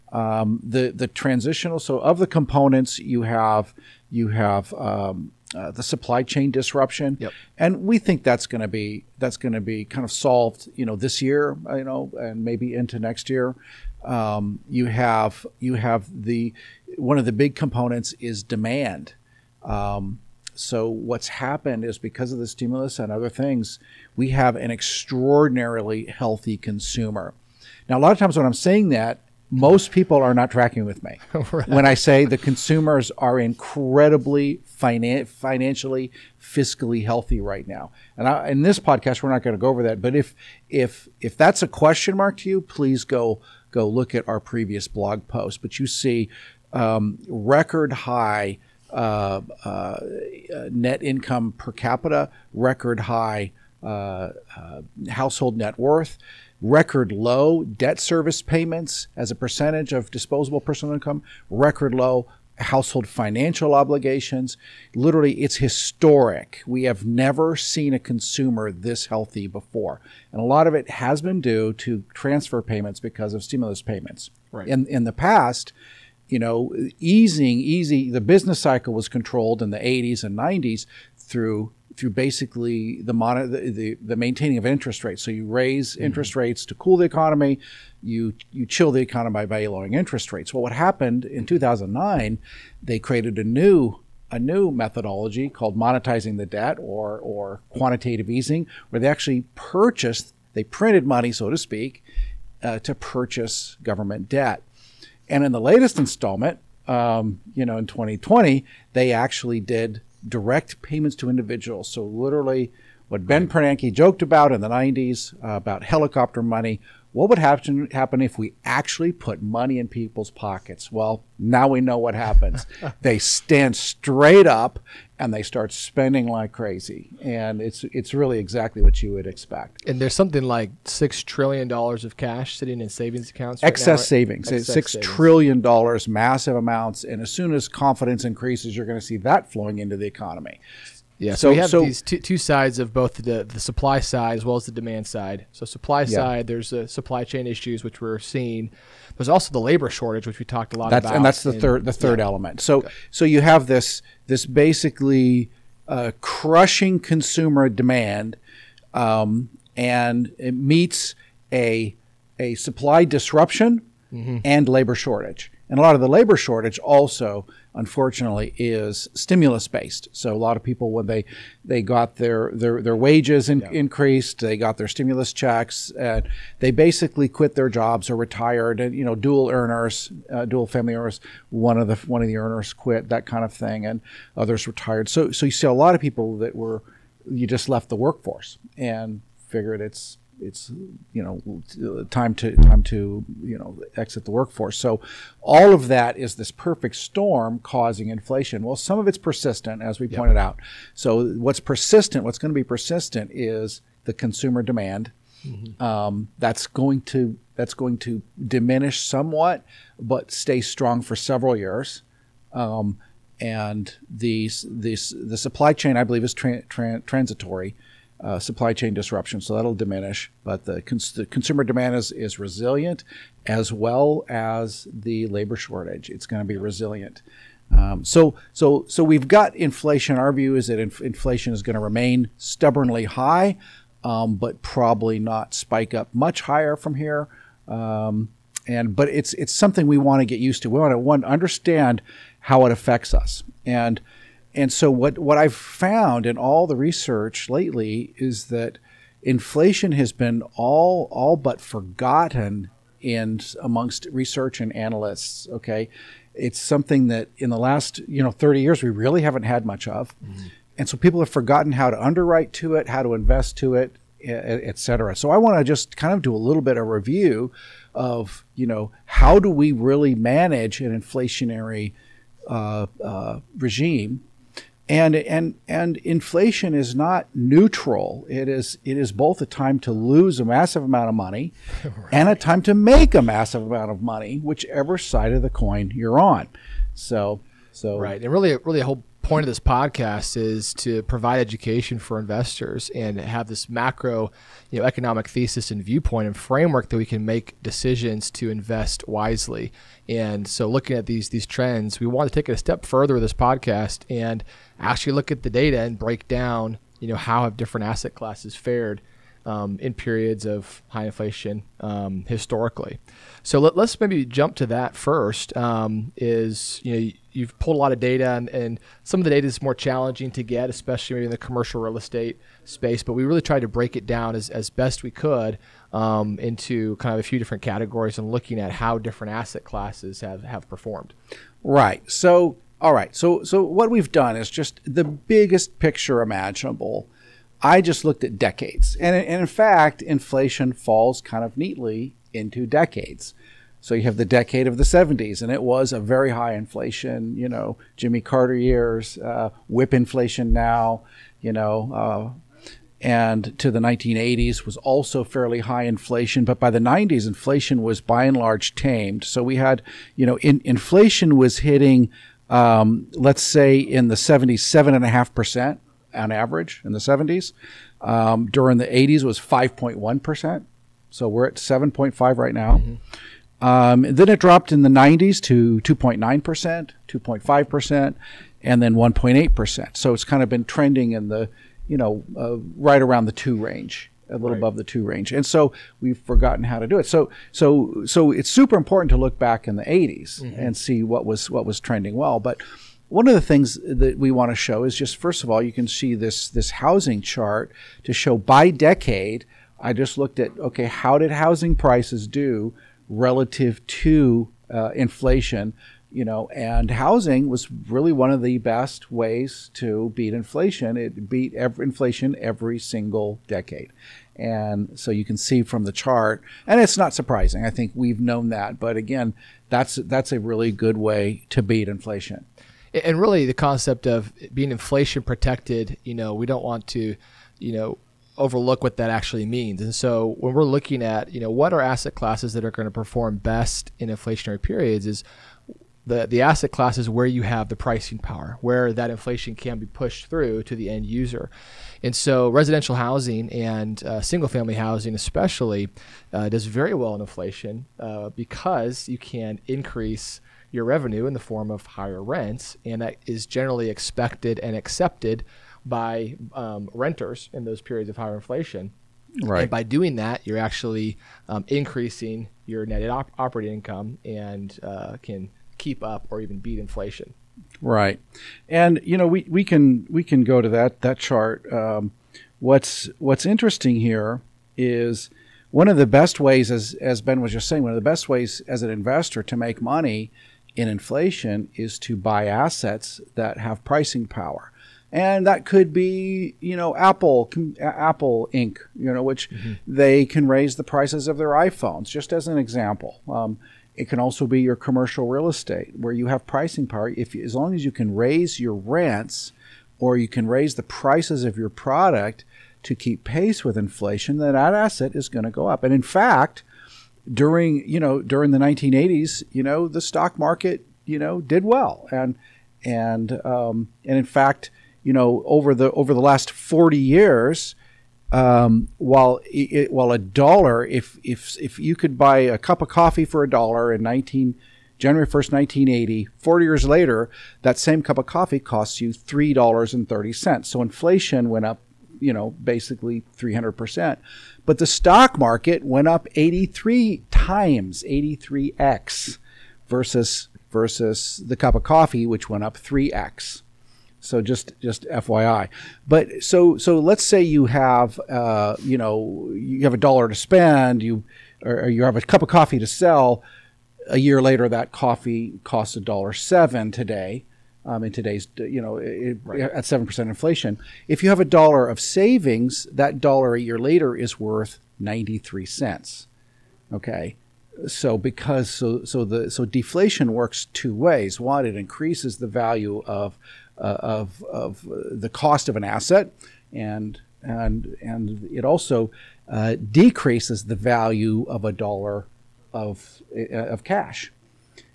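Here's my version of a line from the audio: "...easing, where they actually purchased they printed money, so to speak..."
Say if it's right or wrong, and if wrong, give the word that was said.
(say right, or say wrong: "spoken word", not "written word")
right.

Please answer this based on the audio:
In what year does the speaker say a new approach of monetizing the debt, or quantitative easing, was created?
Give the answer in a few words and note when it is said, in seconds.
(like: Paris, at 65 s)
2009, at 91 s.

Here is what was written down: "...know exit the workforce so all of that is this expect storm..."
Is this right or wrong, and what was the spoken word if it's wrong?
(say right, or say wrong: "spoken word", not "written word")
wrong: "perfect", not "expect".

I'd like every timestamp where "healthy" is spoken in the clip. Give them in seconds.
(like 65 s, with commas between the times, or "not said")
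26 s, 37 s, 69 s.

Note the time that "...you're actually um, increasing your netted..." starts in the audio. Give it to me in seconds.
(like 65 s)
460 s.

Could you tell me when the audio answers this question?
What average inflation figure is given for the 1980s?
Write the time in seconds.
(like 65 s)
369 s.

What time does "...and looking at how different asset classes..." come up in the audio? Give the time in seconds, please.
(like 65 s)
328 s.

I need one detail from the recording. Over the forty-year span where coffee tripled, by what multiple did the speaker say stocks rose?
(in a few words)
83 times.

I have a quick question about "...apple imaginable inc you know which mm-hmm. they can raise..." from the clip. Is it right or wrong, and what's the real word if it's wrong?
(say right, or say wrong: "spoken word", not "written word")
wrong: "apple", not "imaginable".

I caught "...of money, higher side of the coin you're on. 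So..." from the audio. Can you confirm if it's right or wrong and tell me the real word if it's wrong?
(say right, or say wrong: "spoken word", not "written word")
wrong: "whichever", not "higher".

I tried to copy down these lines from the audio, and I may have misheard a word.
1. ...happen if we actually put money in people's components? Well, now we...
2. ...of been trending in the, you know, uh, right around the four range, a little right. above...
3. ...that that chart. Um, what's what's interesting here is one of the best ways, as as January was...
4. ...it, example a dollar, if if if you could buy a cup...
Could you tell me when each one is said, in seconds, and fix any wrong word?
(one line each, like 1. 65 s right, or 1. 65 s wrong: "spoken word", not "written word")
1. 117 s wrong: "pockets", not "components"
2. 380 s wrong: "two", not "four"
3. 470 s wrong: "Ben", not "January"
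4. 519 s wrong: "while", not "example".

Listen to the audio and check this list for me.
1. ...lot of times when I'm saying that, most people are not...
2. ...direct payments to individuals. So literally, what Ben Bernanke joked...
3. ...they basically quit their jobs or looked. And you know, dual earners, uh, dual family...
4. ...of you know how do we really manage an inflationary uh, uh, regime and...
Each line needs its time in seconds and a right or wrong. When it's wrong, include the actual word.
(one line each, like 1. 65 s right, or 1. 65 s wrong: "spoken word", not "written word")
1. 28 s right
2. 110 s right
3. 176 s wrong: "retired", not "looked"
4. 267 s right.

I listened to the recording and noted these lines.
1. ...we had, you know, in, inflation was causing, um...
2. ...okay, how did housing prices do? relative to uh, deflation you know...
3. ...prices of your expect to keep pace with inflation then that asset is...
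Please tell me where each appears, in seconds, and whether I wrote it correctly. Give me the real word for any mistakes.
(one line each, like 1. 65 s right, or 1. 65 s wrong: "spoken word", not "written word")
1. 359 s wrong: "hitting", not "causing"
2. 400 s wrong: "inflation", not "deflation"
3. 500 s wrong: "product", not "expect".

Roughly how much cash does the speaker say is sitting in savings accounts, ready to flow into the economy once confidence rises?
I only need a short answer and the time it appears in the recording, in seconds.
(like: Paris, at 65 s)
6 trillion dollars, at 130 s.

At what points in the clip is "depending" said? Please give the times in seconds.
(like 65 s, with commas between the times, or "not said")
not said.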